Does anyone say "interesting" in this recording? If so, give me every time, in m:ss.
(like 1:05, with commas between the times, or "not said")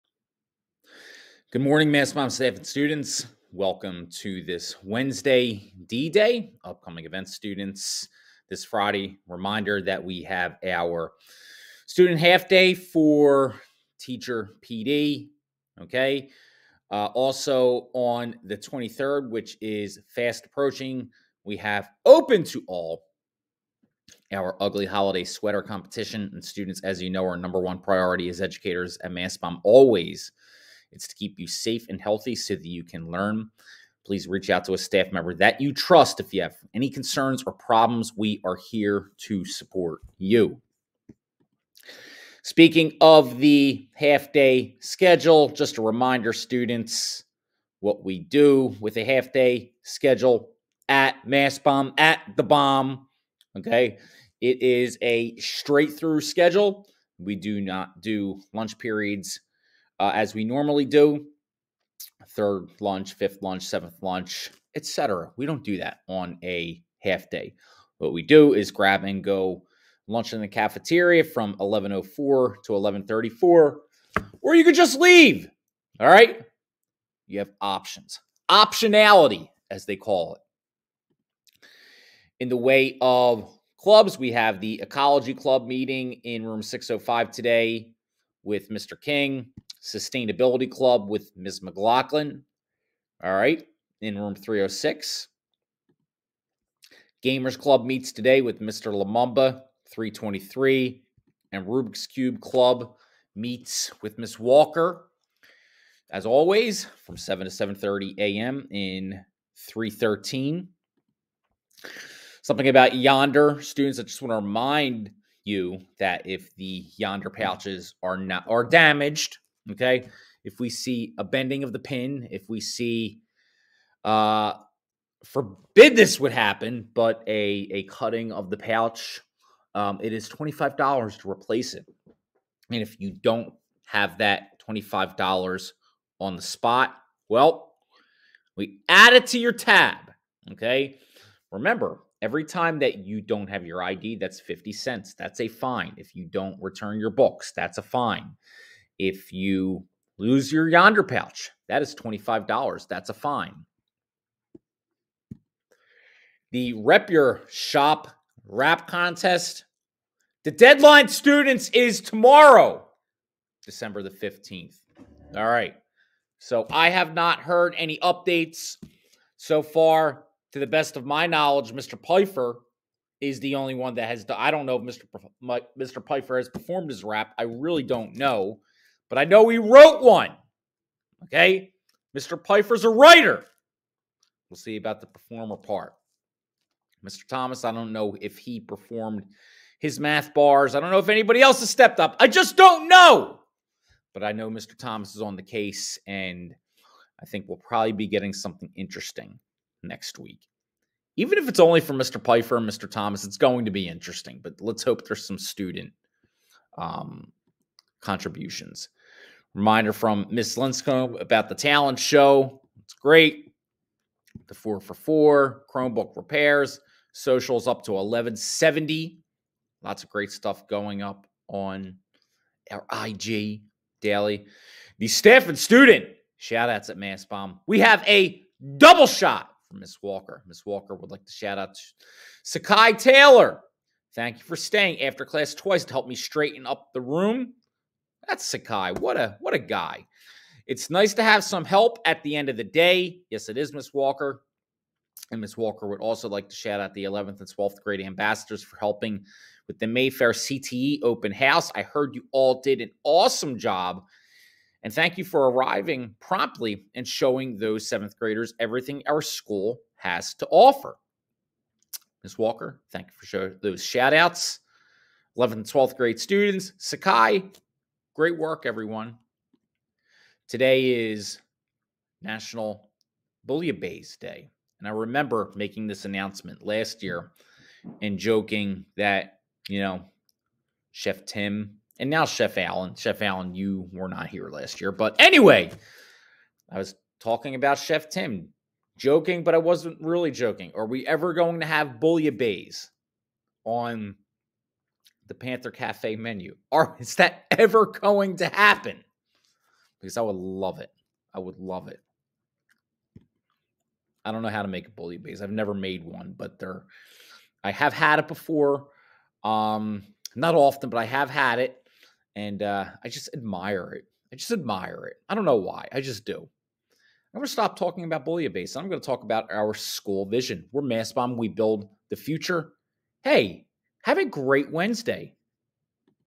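3:18, 3:23.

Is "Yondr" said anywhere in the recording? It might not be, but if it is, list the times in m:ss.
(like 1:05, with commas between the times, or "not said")
1:52, 1:56, 2:30.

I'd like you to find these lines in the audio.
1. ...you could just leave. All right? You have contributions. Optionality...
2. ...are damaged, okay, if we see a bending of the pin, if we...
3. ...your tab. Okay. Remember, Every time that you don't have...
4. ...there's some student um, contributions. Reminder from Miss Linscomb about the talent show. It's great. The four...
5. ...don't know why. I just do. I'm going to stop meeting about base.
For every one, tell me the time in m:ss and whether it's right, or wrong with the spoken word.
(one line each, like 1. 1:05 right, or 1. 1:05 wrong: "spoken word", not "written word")
1. 1:14 wrong: "options", not "contributions"
2. 1:58 right
3. 2:19 right
4. 3:25 right
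5. 5:15 wrong: "talking", not "meeting".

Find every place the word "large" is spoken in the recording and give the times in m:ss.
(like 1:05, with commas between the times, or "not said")
not said.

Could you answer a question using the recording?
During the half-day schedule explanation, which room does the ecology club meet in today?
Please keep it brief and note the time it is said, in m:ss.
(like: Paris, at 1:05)
605, at 1:26.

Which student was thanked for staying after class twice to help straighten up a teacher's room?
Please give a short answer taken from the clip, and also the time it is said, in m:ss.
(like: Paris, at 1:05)
Sakai Taylor, at 3:52.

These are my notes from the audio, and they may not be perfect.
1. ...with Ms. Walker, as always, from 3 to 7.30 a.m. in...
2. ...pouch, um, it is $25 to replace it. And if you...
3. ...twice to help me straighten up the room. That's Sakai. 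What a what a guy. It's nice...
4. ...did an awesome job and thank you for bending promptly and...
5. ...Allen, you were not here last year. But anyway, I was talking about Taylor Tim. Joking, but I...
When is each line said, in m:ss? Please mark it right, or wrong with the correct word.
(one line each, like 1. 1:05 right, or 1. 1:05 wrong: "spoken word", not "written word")
1. 1:44 wrong: "7", not "3"
2. 2:08 right
3. 3:55 right
4. 4:12 wrong: "arriving", not "bending"
5. 4:43 wrong: "Chef", not "Taylor".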